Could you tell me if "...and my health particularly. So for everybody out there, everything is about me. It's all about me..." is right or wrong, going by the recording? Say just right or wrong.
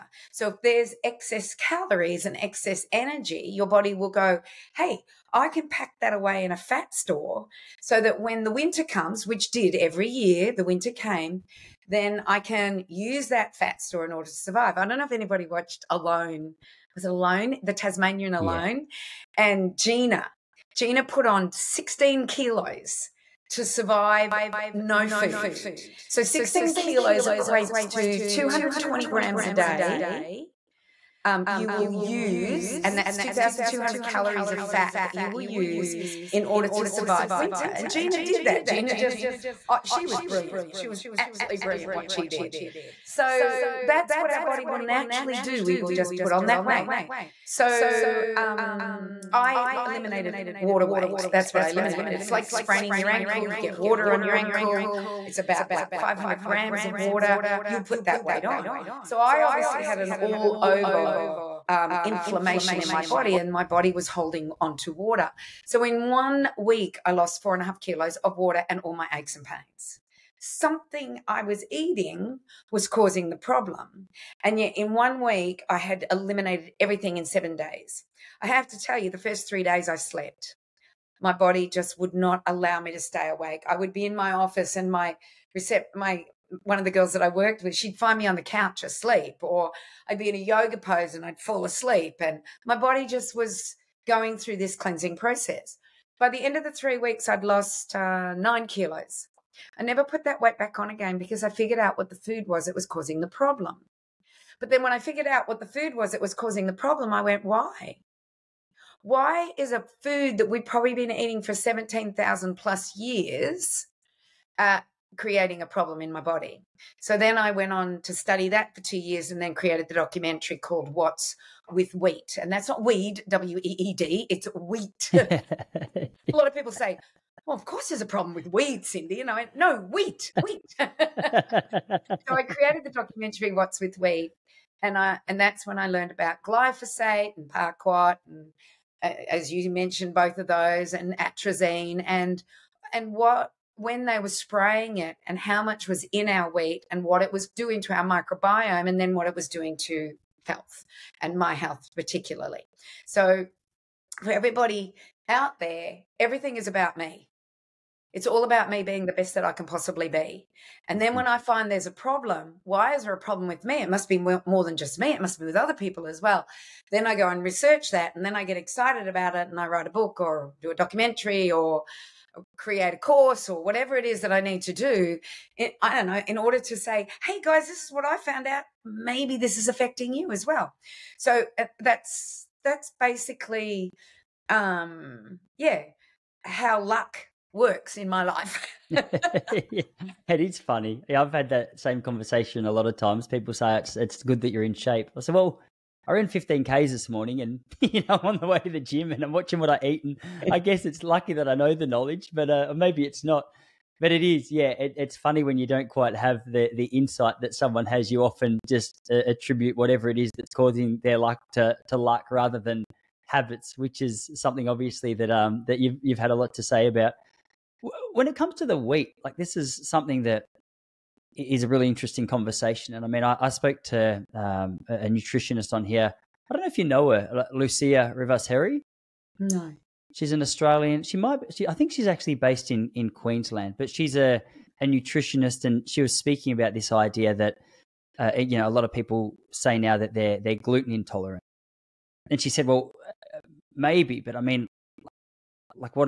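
right.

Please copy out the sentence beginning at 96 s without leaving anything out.
By the end of the three weeks, I'd lost uh, nine kilos.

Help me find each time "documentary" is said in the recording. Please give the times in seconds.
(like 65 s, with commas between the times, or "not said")
119 s, 132 s, 170 s.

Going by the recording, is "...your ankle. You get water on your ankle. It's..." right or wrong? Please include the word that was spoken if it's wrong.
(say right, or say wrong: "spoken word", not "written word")
right.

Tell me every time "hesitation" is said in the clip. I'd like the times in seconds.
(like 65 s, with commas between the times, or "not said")
not said.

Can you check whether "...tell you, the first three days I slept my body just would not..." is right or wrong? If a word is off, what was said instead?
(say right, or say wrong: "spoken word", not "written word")
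right.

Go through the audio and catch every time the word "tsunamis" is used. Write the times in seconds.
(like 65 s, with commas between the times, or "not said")
not said.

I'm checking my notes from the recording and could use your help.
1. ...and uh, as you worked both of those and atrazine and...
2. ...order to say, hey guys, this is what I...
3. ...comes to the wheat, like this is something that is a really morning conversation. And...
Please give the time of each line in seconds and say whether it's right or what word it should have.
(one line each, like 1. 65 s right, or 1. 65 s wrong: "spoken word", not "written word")
1. 138 s wrong: "mentioned", not "worked"
2. 176 s right
3. 218 s wrong: "interesting", not "morning".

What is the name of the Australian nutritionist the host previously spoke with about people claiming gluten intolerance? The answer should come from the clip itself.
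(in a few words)
Lucia Rivas Harry.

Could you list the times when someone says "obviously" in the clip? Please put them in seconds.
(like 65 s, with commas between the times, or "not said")
59 s, 214 s.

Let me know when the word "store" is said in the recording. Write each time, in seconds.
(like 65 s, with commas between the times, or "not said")
6 s, 13 s.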